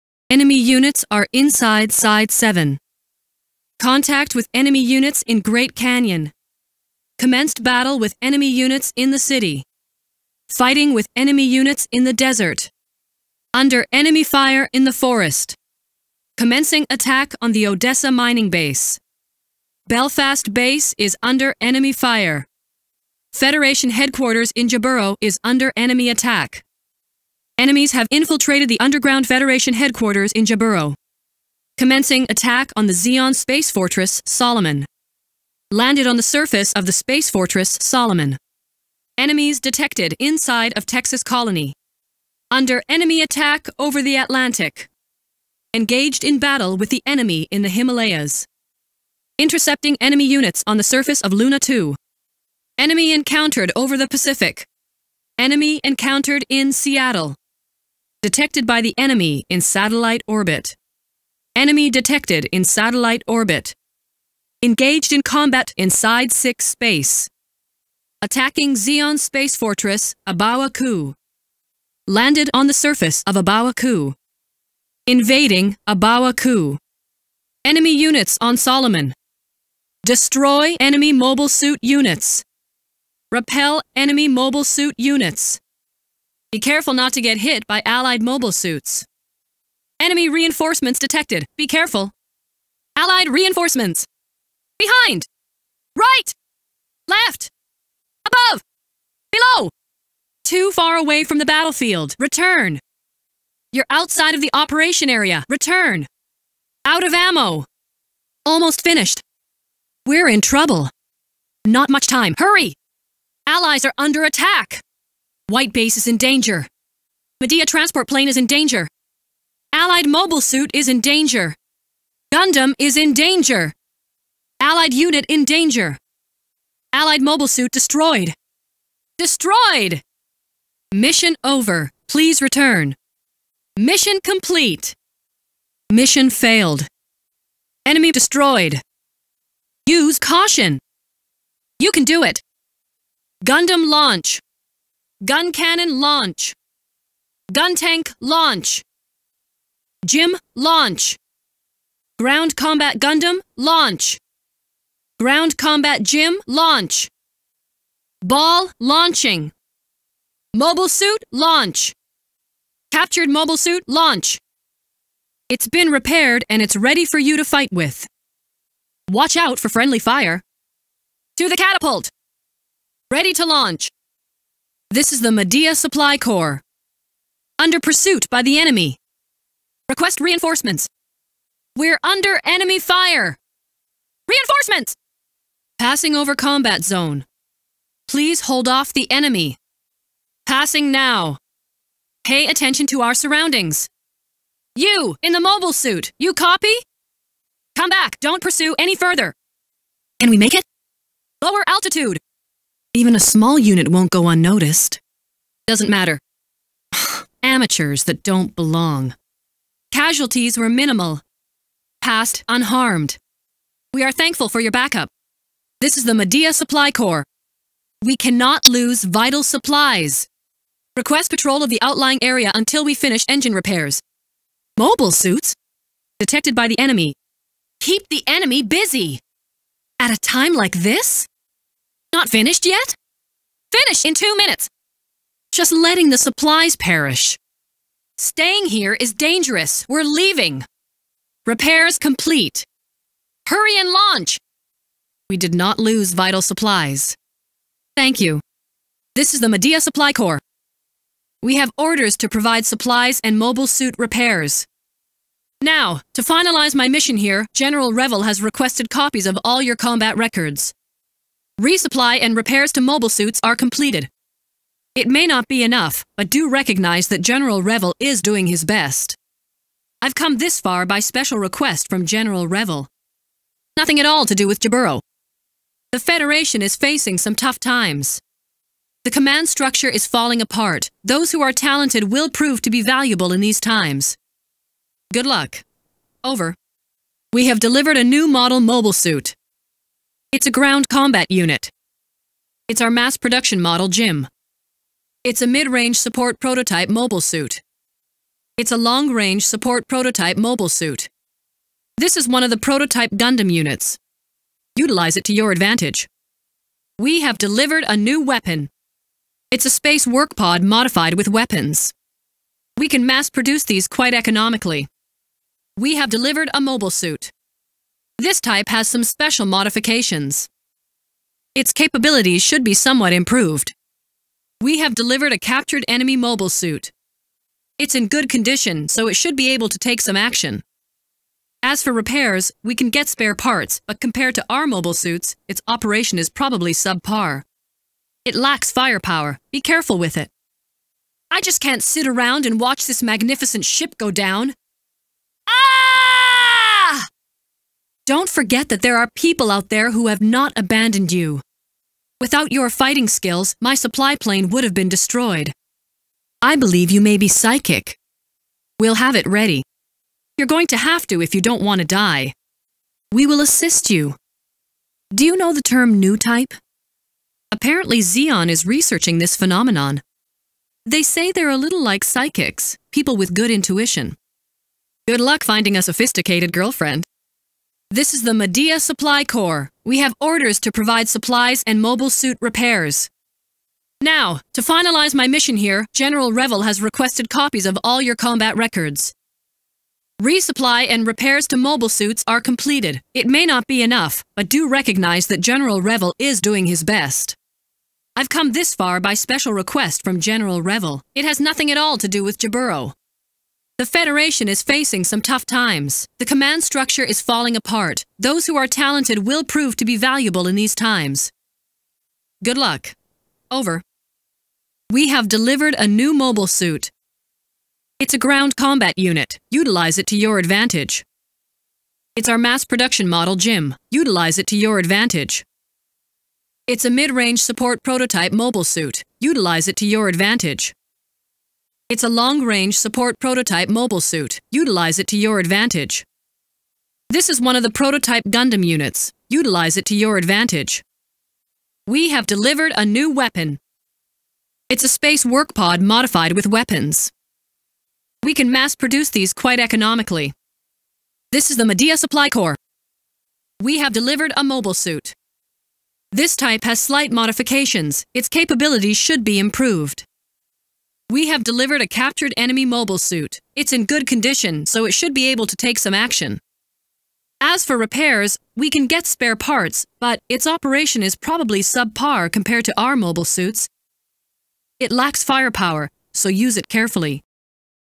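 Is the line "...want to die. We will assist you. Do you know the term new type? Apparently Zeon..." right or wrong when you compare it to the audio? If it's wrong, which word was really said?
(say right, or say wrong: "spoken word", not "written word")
right.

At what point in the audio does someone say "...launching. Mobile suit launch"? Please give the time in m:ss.
2:38.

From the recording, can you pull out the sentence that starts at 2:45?
It's been repaired and it's ready for you to fight with.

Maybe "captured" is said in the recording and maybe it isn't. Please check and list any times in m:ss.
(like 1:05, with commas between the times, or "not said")
2:42, 5:25, 7:41.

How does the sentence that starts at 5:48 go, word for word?
Don't forget that there are people out there who have not abandoned you.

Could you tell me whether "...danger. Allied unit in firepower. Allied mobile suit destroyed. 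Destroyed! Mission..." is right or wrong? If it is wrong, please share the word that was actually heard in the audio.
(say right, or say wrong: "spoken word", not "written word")
wrong: "danger", not "firepower".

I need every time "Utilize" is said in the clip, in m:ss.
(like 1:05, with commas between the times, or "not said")
5:04, 6:59, 7:03, 7:09, 7:14, 7:19.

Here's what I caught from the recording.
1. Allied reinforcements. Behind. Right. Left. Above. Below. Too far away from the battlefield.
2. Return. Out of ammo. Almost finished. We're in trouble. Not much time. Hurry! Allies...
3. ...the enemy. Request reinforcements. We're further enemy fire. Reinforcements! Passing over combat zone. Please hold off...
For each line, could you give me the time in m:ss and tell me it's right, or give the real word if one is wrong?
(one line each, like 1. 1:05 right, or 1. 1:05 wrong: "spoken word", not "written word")
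1. 1:32 right
2. 1:45 right
3. 2:58 wrong: "under", not "further".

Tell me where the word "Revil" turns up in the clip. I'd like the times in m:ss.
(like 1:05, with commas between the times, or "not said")
4:17, 4:27, 4:32, 6:26, 6:35.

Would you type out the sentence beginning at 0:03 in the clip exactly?
Contact with enemy units in Great Canyon.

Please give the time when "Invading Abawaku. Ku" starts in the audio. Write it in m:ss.
1:15.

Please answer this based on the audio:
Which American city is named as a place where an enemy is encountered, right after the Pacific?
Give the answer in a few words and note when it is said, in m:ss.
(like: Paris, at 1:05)
Seattle, at 0:56.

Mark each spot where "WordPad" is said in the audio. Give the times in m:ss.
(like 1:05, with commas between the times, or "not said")
not said.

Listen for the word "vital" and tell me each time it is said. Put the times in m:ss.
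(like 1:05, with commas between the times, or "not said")
3:39, 4:06.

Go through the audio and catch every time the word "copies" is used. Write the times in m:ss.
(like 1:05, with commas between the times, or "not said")
4:18, 6:27.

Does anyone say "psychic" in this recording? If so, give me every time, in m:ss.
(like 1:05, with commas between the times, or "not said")
5:57, 6:12.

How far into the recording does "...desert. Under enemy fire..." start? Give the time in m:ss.
0:12.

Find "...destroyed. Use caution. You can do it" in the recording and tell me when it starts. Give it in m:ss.
2:18.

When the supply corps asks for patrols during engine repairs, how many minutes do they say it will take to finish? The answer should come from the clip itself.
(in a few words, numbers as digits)
2 minutes.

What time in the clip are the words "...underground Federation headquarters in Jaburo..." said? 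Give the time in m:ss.
0:28.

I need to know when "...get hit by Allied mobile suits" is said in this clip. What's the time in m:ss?
1:27.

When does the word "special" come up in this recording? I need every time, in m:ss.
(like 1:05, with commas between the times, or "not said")
4:31, 5:19, 6:39.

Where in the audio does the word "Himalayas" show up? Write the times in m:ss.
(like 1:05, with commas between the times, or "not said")
0:47.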